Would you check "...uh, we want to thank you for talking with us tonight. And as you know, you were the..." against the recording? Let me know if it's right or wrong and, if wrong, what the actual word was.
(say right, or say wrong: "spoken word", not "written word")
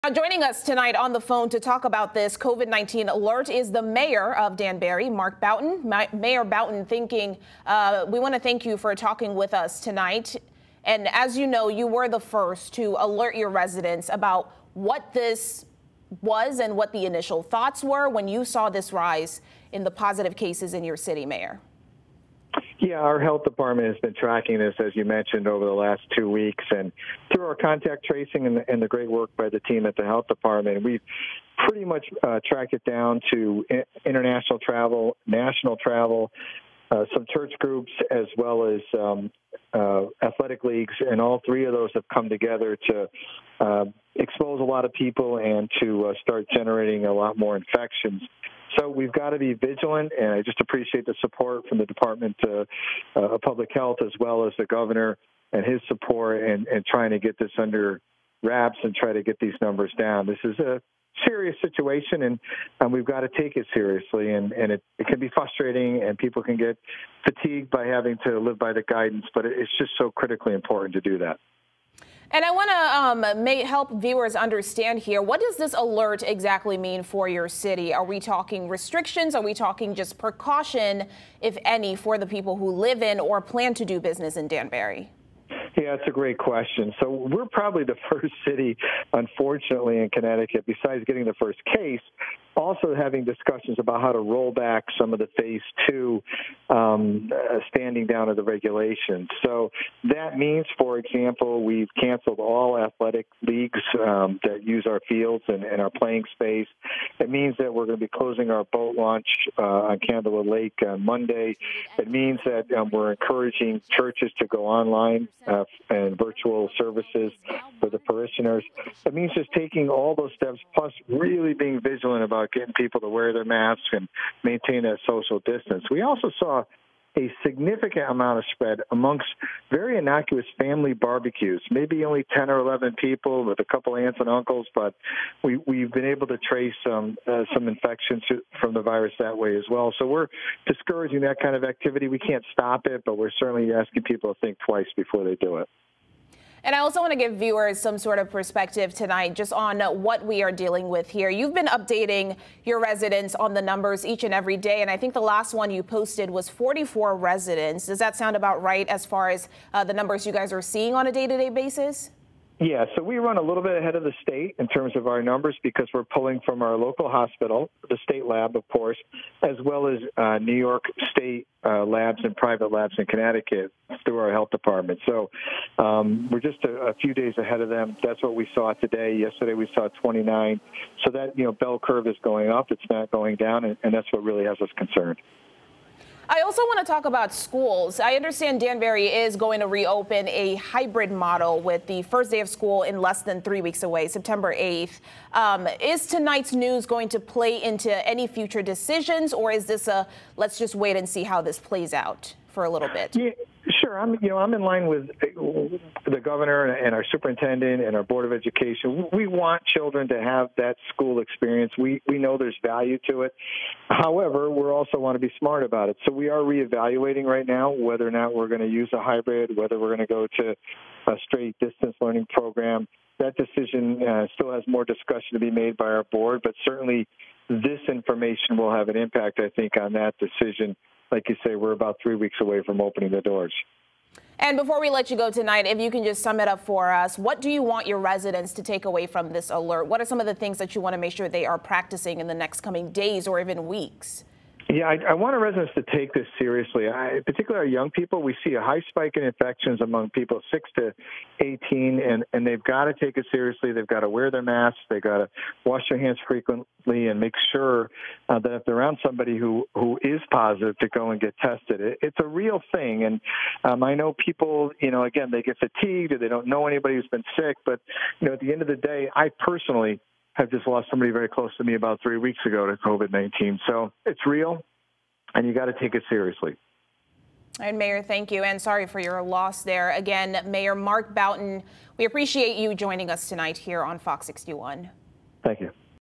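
right.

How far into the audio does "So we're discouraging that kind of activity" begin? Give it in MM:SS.
02:19.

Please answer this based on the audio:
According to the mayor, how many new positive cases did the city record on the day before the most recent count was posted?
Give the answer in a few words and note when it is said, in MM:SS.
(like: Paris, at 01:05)
29, at 02:59.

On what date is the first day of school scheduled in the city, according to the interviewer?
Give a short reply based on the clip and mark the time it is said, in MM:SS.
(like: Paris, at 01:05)
September 8th, at 03:14.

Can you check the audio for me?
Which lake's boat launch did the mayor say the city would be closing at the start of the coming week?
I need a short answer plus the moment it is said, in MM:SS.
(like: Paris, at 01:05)
Candlewood Lake, at 01:49.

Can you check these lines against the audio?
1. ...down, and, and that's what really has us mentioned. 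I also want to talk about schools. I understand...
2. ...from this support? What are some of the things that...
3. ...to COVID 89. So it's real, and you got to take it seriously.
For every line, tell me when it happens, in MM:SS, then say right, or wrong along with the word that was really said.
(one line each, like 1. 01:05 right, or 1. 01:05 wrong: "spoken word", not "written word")
1. 03:03 wrong: "concerned", not "mentioned"
2. 03:59 wrong: "alert", not "support"
3. 04:32 wrong: "19", not "89".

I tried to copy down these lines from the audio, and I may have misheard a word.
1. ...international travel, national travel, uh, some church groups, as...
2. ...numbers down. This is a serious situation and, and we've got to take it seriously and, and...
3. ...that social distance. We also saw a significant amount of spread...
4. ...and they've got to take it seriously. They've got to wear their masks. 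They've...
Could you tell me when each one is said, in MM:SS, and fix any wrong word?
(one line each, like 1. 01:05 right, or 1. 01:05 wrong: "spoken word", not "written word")
1. 00:34 right
2. 00:59 right
3. 02:04 right
4. 04:12 right.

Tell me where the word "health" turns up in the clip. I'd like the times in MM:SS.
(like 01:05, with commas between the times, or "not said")
00:23, 00:30, 00:53, 02:54.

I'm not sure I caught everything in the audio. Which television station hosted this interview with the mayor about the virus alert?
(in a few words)
Fox 61.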